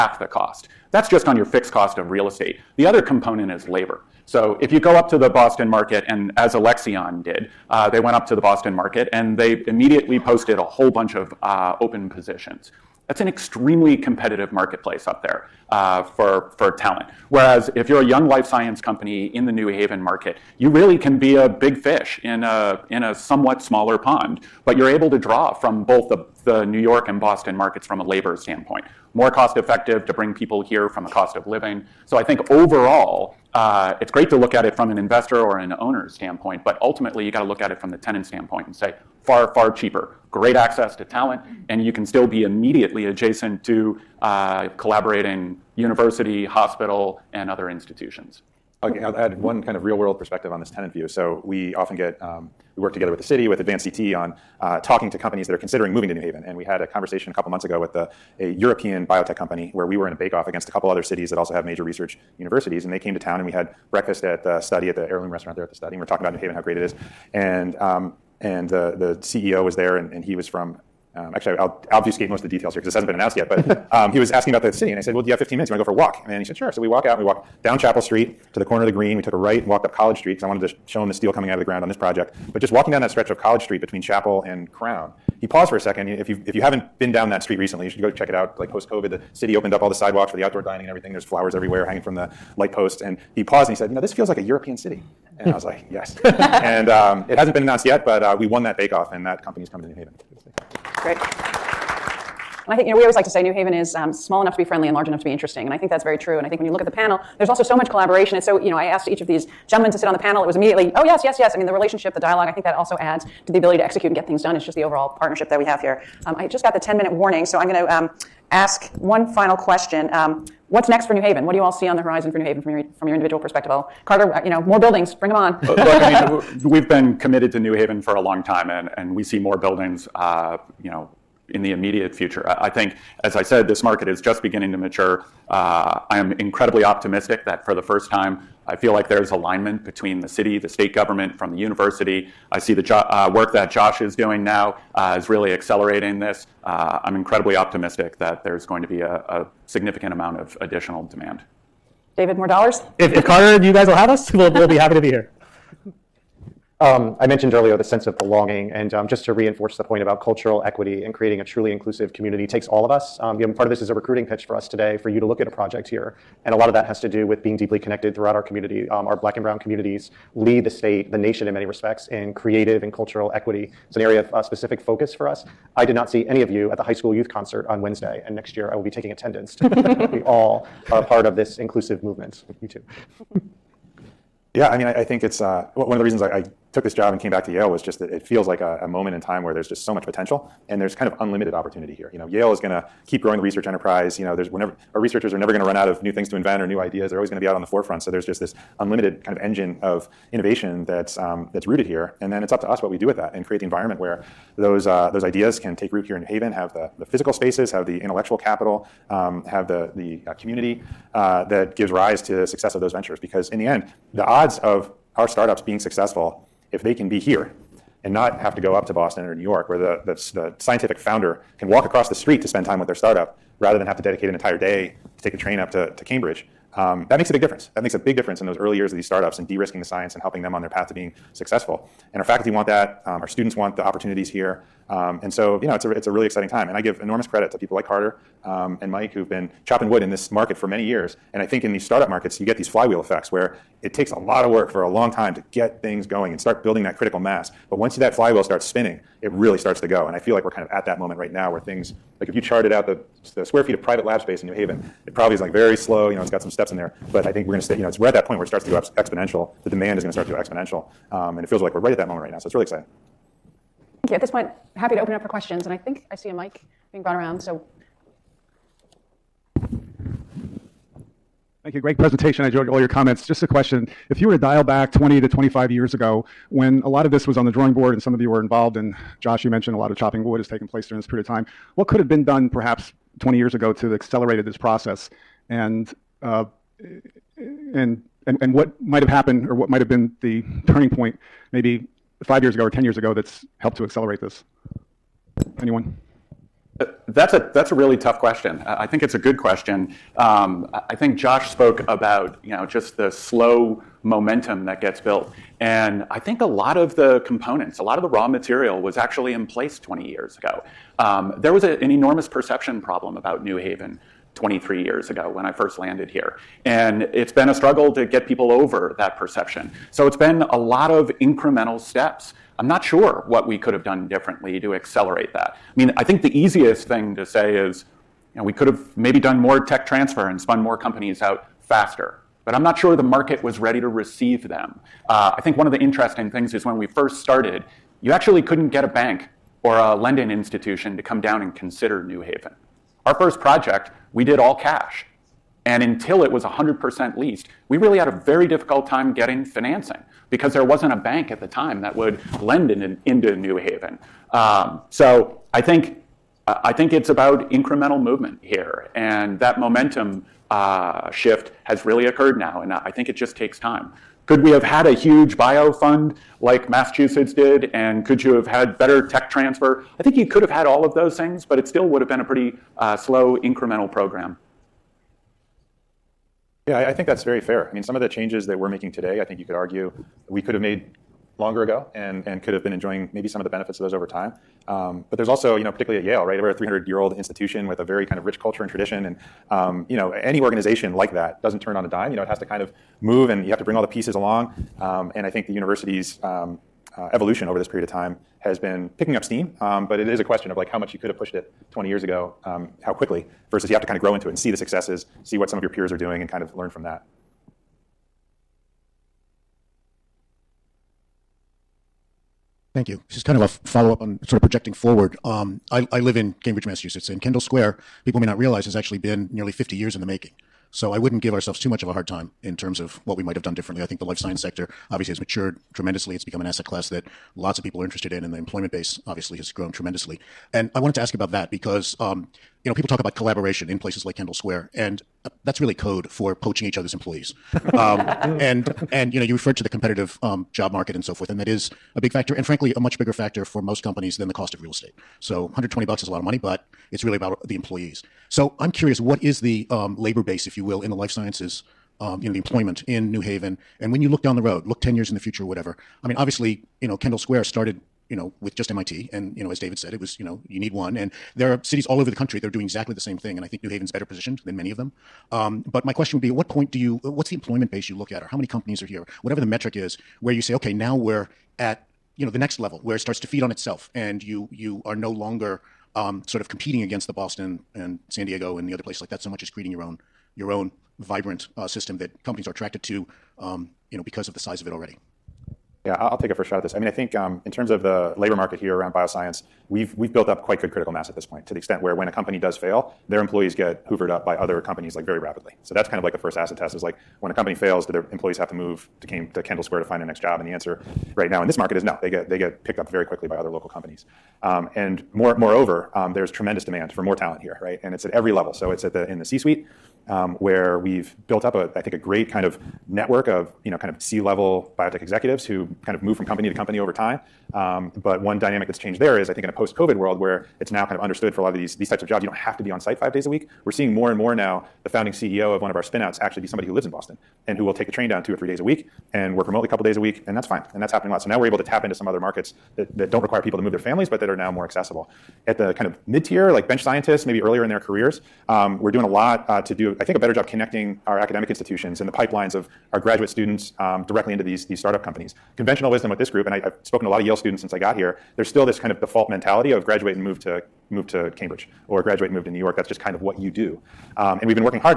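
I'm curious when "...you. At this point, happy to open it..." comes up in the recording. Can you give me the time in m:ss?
4:24.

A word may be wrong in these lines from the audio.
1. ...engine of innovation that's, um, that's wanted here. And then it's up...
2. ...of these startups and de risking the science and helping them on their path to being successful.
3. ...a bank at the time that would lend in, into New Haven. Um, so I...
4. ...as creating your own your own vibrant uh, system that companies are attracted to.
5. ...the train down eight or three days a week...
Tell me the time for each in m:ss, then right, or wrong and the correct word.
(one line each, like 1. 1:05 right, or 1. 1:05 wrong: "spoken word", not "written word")
1. 3:19 wrong: "rooted", not "wanted"
2. 3:48 right
3. 5:50 right
4. 7:59 right
5. 8:47 wrong: "two", not "eight".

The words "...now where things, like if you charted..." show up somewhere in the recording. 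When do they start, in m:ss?
4:11.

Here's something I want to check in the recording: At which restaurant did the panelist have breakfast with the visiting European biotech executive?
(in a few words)
Heirloom.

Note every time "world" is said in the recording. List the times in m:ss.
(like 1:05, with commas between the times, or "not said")
0:49, 8:39.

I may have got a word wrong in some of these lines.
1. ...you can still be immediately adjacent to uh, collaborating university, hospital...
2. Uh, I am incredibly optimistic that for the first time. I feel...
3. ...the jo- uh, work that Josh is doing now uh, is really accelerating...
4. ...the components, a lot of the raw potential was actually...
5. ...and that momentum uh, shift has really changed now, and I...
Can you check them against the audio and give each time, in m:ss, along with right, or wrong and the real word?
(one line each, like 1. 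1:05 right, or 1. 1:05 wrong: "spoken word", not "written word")
1. 0:41 right
2. 2:15 right
3. 2:22 right
4. 5:06 wrong: "material", not "potential"
5. 5:58 wrong: "occurred", not "changed".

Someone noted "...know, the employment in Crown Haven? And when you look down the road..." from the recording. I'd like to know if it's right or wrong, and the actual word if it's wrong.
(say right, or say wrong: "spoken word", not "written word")
wrong: "New", not "Crown".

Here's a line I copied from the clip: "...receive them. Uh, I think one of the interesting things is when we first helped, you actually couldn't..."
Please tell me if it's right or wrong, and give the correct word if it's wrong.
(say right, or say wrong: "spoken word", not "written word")
wrong: "started", not "helped".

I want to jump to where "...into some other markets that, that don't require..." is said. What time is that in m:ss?
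8:51.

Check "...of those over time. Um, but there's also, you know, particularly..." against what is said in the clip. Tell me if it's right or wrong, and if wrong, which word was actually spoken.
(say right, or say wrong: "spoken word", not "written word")
right.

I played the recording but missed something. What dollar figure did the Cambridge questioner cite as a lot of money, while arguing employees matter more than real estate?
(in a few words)
120.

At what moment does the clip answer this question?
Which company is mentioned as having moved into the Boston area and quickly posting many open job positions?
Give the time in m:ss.
0:06.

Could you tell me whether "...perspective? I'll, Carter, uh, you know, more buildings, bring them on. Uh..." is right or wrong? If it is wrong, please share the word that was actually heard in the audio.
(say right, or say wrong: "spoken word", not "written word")
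right.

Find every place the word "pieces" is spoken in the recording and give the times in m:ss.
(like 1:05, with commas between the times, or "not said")
6:33.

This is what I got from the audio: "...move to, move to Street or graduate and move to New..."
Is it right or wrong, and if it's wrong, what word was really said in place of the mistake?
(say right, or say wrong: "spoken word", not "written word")
wrong: "Cambridge", not "Street".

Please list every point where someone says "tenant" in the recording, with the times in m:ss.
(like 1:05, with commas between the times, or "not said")
0:37, 0:50.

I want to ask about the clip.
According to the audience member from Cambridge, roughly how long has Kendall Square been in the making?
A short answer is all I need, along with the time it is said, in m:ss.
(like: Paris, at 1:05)
Nearly 50 years, at 6:59.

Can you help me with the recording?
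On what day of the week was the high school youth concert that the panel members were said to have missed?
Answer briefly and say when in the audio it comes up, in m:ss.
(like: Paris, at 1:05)
Wednesday, at 2:57.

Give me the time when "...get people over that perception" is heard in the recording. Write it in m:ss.
5:18.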